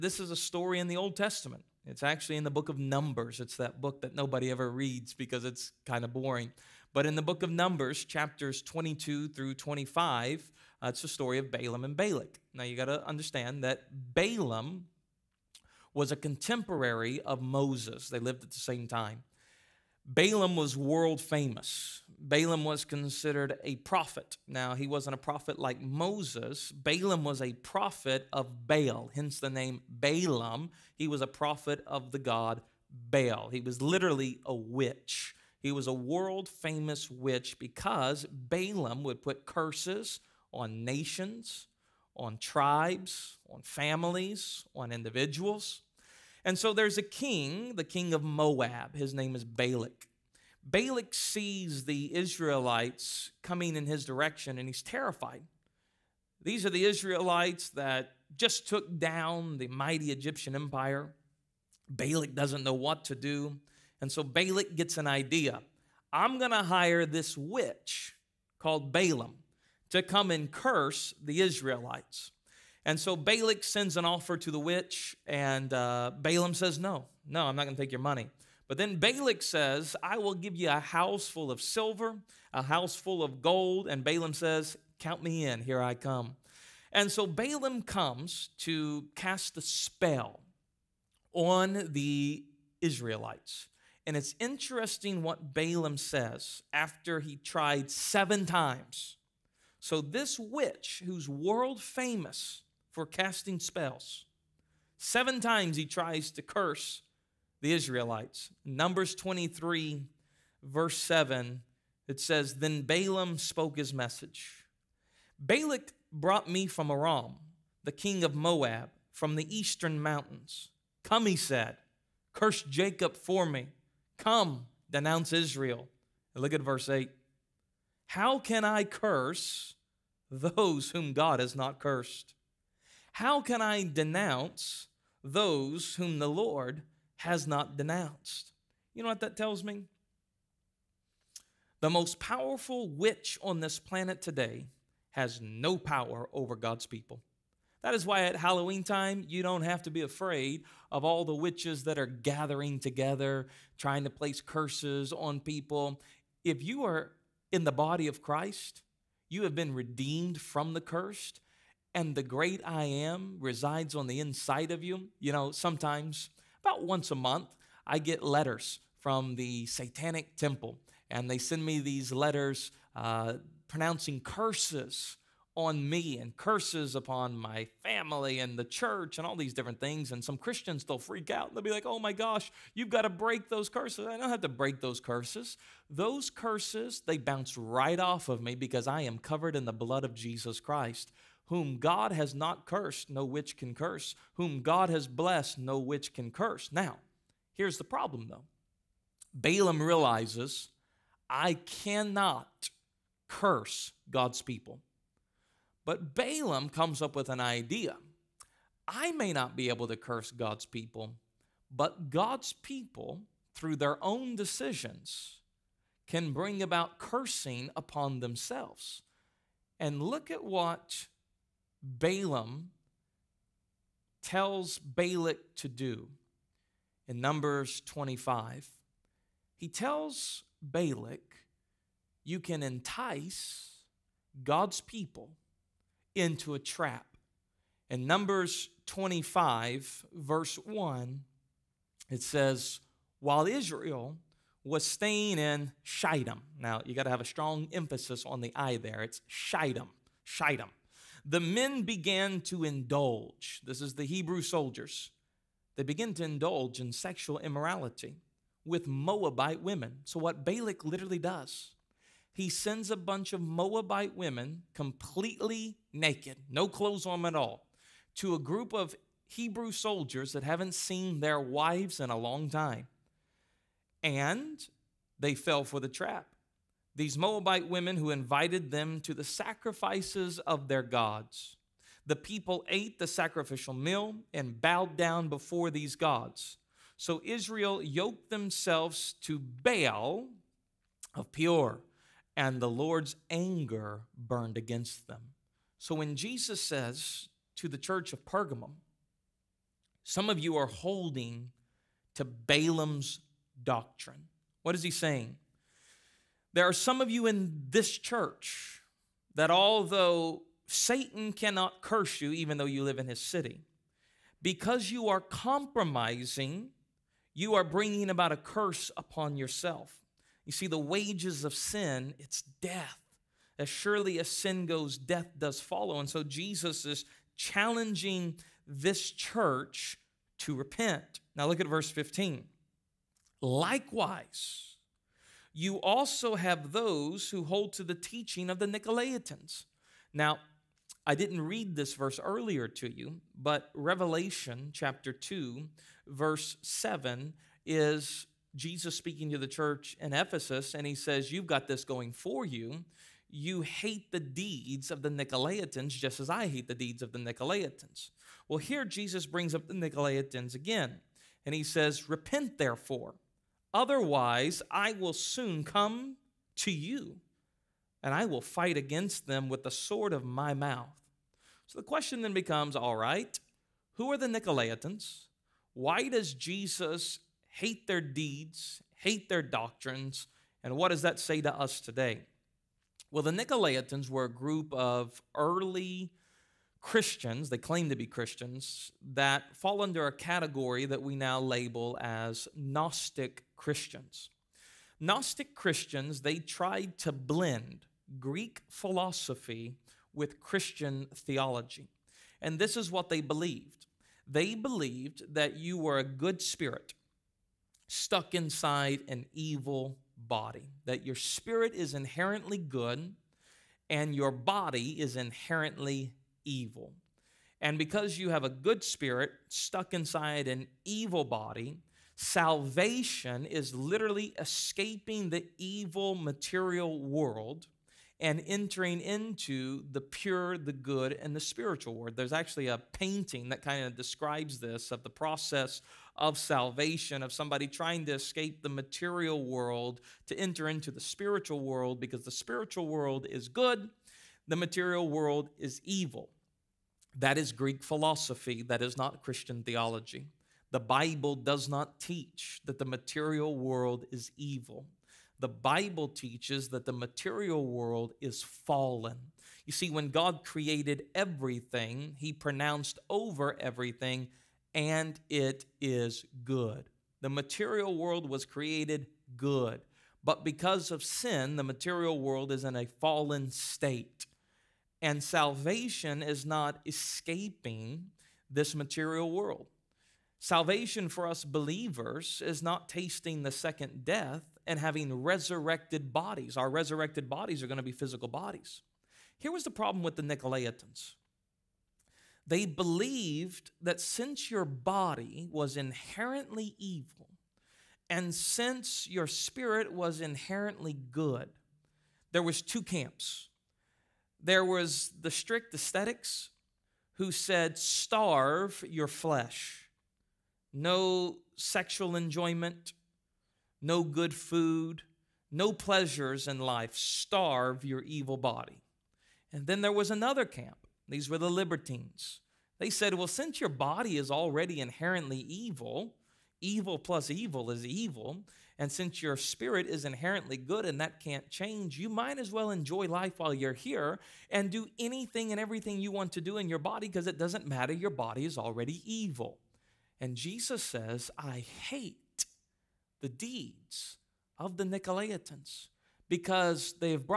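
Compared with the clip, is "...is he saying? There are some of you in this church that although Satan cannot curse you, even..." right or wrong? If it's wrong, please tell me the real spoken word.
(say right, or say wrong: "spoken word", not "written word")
right.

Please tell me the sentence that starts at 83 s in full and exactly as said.
And Balaam says, Count me in, here I come.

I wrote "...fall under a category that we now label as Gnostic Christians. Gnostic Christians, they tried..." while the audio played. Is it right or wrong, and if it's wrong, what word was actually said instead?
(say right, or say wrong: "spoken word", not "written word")
right.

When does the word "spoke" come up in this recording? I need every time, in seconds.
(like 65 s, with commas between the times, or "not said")
113 s.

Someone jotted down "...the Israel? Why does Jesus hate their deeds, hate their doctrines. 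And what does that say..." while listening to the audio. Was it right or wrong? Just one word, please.
wrong.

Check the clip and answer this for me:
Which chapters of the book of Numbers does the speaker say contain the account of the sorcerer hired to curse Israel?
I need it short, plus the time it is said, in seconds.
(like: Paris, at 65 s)
22 through 25, at 8 s.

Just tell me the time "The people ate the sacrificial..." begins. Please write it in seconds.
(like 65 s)
282 s.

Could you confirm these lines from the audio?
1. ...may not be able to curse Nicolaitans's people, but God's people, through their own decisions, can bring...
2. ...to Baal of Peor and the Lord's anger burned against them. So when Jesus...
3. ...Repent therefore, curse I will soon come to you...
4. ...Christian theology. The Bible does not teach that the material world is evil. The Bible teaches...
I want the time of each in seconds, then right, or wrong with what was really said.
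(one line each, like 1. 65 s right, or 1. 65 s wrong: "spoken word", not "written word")
1. 209 s wrong: "God", not "Nicolaitans"
2. 289 s right
3. 362 s wrong: "otherwise", not "curse"
4. 449 s right.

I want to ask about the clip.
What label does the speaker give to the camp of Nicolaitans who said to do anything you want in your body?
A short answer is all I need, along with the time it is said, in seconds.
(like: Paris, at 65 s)
libertines, at 521 s.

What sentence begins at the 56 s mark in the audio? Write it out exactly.
These are the Israelites that just took down the mighty Egyptian empire.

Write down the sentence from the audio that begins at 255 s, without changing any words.
They begin to indulge in sexual immorality with Moabite women.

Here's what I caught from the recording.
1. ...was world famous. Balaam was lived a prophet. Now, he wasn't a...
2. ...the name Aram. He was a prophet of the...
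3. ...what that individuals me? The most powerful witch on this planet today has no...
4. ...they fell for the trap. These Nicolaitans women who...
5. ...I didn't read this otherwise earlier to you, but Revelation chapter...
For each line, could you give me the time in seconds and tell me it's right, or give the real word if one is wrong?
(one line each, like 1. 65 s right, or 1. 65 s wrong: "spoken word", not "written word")
1. 20 s wrong: "considered", not "lived"
2. 29 s wrong: "Balaam", not "Aram"
3. 139 s wrong: "tells", not "individuals"
4. 275 s wrong: "Moabite", not "Nicolaitans"
5. 341 s wrong: "verse", not "otherwise".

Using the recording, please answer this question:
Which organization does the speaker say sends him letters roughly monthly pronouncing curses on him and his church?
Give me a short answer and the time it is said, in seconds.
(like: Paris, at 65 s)
The Satanic Temple, at 169 s.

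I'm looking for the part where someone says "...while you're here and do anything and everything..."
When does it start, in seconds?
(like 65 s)
533 s.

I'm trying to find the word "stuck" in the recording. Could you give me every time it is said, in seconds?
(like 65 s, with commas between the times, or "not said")
407 s, 419 s.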